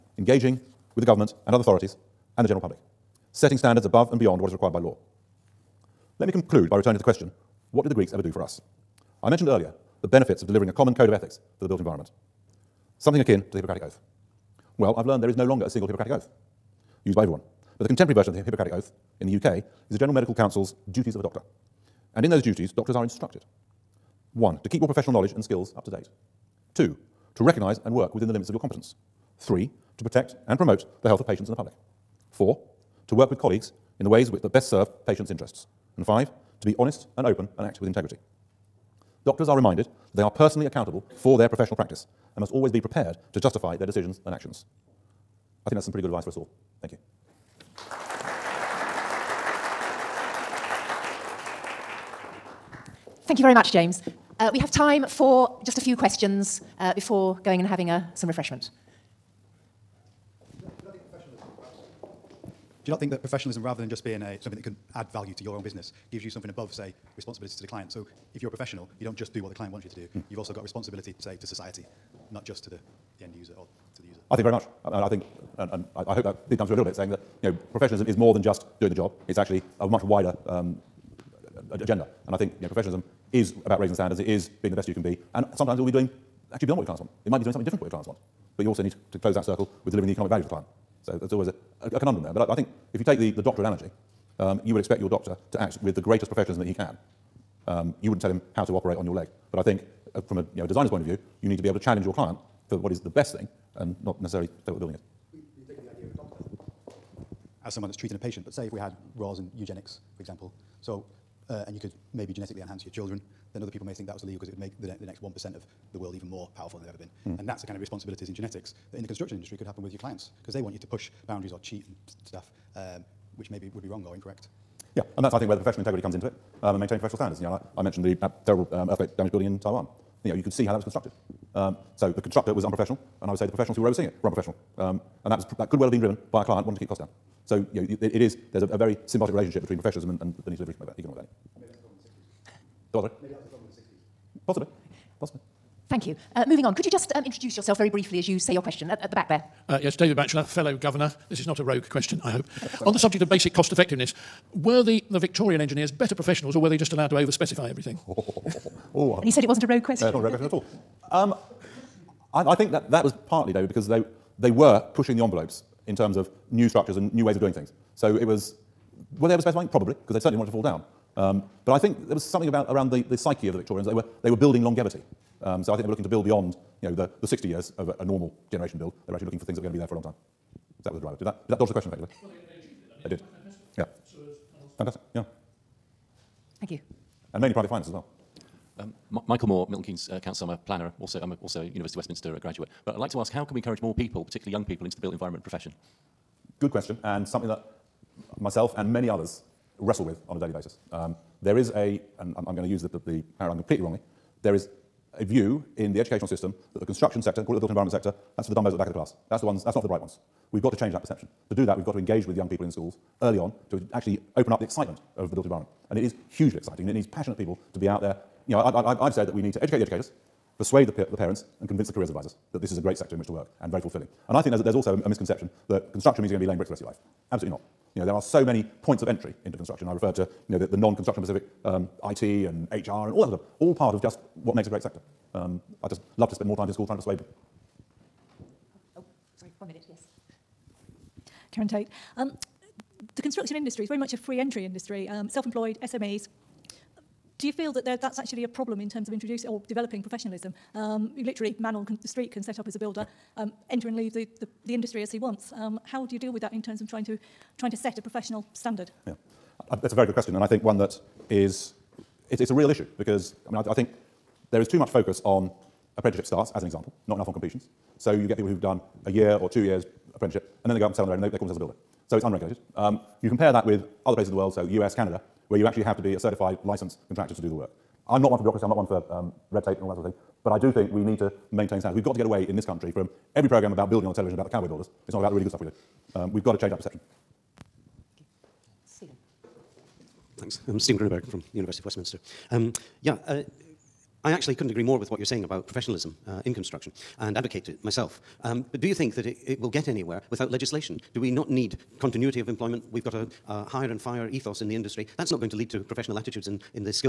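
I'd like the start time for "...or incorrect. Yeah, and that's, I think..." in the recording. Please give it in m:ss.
2:04.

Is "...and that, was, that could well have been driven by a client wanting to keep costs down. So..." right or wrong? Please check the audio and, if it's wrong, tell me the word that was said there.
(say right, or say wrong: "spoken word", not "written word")
right.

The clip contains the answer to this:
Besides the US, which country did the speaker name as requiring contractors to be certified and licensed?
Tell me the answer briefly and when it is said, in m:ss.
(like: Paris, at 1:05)
Canada, at 4:34.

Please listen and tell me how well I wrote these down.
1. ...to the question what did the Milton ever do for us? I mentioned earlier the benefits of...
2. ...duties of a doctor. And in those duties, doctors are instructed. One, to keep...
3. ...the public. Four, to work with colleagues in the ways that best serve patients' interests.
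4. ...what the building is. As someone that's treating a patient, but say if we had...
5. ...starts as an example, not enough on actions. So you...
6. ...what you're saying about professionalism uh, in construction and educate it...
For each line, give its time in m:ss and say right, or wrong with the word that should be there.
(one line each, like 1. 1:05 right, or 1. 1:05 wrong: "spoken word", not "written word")
1. 0:06 wrong: "Greeks", not "Milton"
2. 0:20 right
3. 0:31 right
4. 1:44 right
5. 4:26 wrong: "completions", not "actions"
6. 4:55 wrong: "advocate", not "educate".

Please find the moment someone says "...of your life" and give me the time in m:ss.
3:46.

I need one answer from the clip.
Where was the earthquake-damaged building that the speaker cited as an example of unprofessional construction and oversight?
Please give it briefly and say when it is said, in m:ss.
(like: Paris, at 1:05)
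Taiwan, at 2:09.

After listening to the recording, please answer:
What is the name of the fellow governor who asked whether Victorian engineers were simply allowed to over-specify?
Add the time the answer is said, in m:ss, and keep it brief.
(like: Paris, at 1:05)
David Batchelor, at 2:29.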